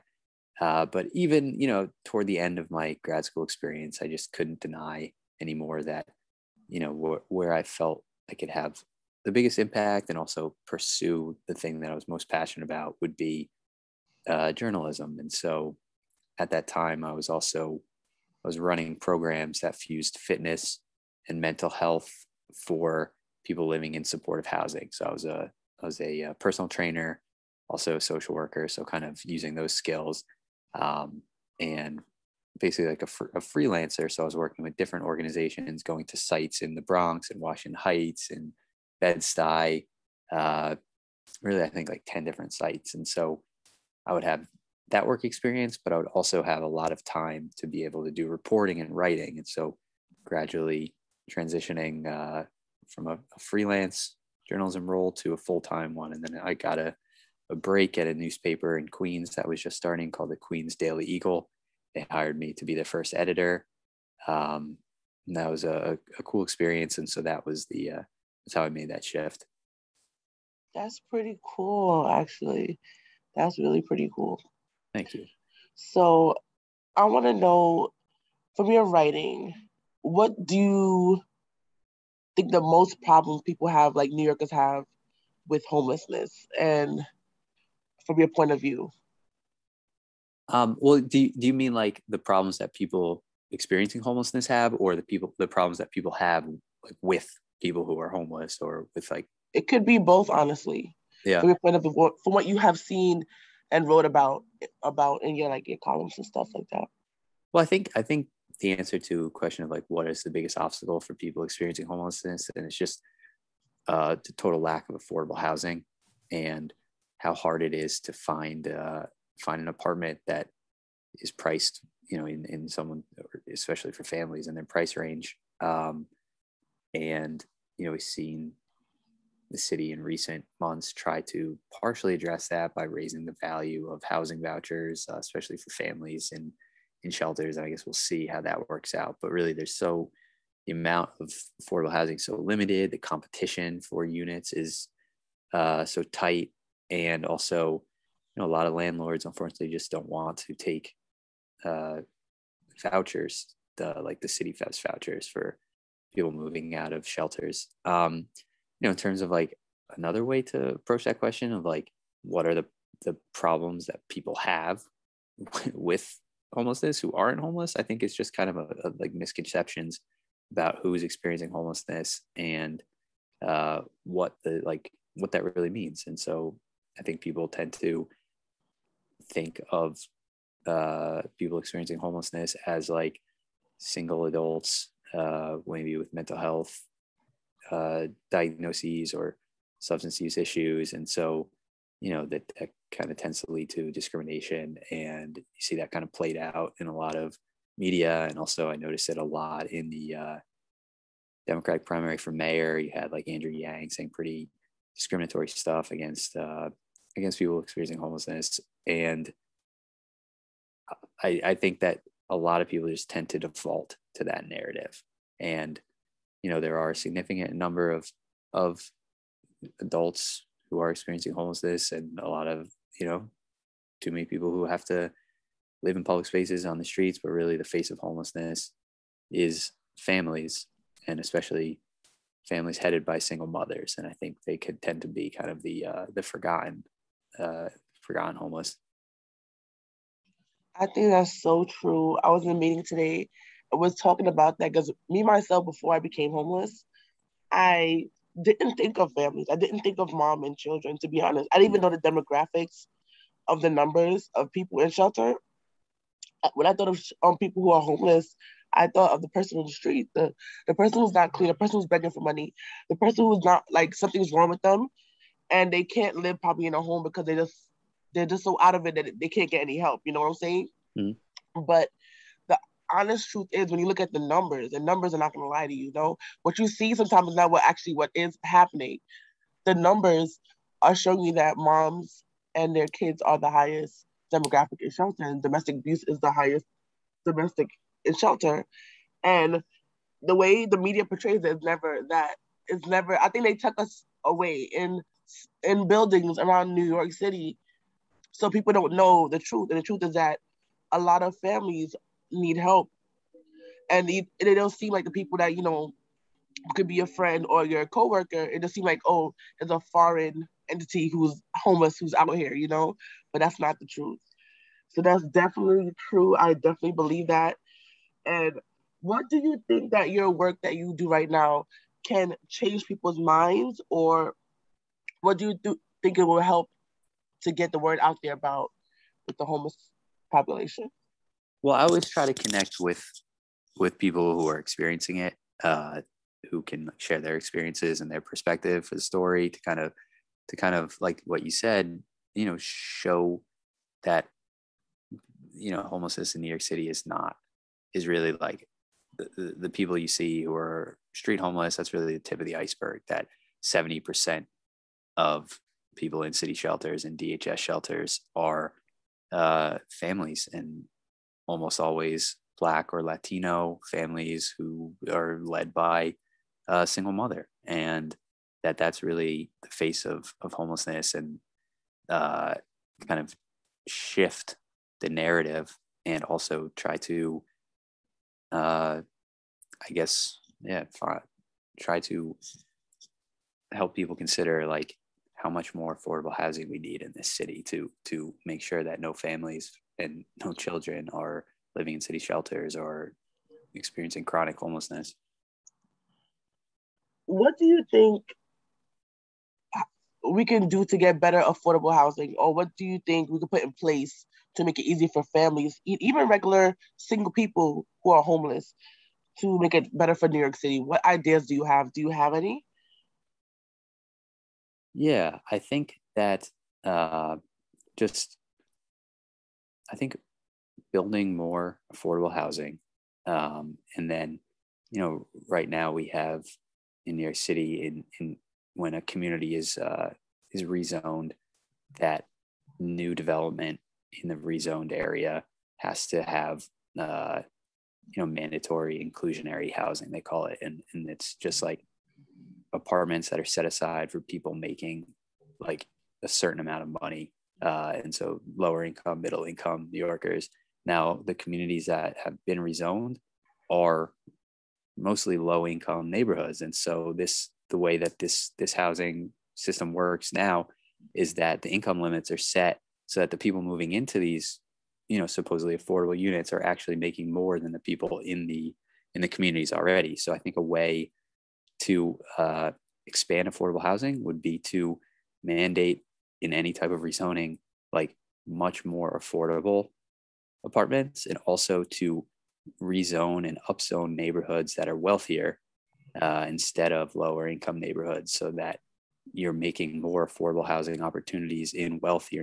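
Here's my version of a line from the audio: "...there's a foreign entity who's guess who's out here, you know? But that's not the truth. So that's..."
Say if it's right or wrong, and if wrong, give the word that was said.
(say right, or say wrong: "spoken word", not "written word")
wrong: "homeless", not "guess".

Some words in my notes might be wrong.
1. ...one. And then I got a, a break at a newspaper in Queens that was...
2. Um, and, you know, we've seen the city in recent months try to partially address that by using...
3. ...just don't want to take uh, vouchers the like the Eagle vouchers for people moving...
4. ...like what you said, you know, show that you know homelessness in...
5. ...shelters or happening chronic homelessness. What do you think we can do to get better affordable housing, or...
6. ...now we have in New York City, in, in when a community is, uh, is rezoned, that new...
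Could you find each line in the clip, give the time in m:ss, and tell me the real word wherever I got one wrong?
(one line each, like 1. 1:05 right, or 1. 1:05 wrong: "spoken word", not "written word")
1. 0:55 right
2. 2:05 wrong: "raising", not "using"
3. 2:29 wrong: "CityFHEPS", not "Eagle"
4. 5:40 right
5. 6:32 wrong: "experiencing", not "happening"
6. 7:05 right.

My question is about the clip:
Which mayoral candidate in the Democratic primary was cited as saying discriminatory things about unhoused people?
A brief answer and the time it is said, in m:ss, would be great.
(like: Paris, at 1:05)
Andrew Yang, at 3:23.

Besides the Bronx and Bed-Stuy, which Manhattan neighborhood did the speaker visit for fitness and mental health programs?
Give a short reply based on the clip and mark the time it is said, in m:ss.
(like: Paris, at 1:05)
Washington Heights, at 0:37.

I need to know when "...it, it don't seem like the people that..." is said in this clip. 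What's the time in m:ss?
5:04.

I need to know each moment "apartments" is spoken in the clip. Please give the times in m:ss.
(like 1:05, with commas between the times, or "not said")
1:59, 7:22, 8:00.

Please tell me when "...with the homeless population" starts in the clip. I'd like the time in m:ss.
5:29.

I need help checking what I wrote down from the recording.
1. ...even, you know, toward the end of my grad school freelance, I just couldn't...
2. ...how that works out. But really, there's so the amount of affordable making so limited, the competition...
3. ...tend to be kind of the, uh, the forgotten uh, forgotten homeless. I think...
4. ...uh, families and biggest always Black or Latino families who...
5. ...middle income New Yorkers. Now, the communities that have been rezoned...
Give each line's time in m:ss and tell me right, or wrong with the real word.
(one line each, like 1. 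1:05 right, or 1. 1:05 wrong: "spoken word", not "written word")
1. 0:01 wrong: "experience", not "freelance"
2. 2:18 wrong: "housing", not "making"
3. 3:54 right
4. 5:59 wrong: "almost", not "biggest"
5. 7:29 right.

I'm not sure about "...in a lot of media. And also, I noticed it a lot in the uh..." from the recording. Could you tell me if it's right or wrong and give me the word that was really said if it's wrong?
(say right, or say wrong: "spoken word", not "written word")
right.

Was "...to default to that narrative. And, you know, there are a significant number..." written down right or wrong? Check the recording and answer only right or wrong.
right.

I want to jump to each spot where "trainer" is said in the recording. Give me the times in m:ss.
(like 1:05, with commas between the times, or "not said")
0:26.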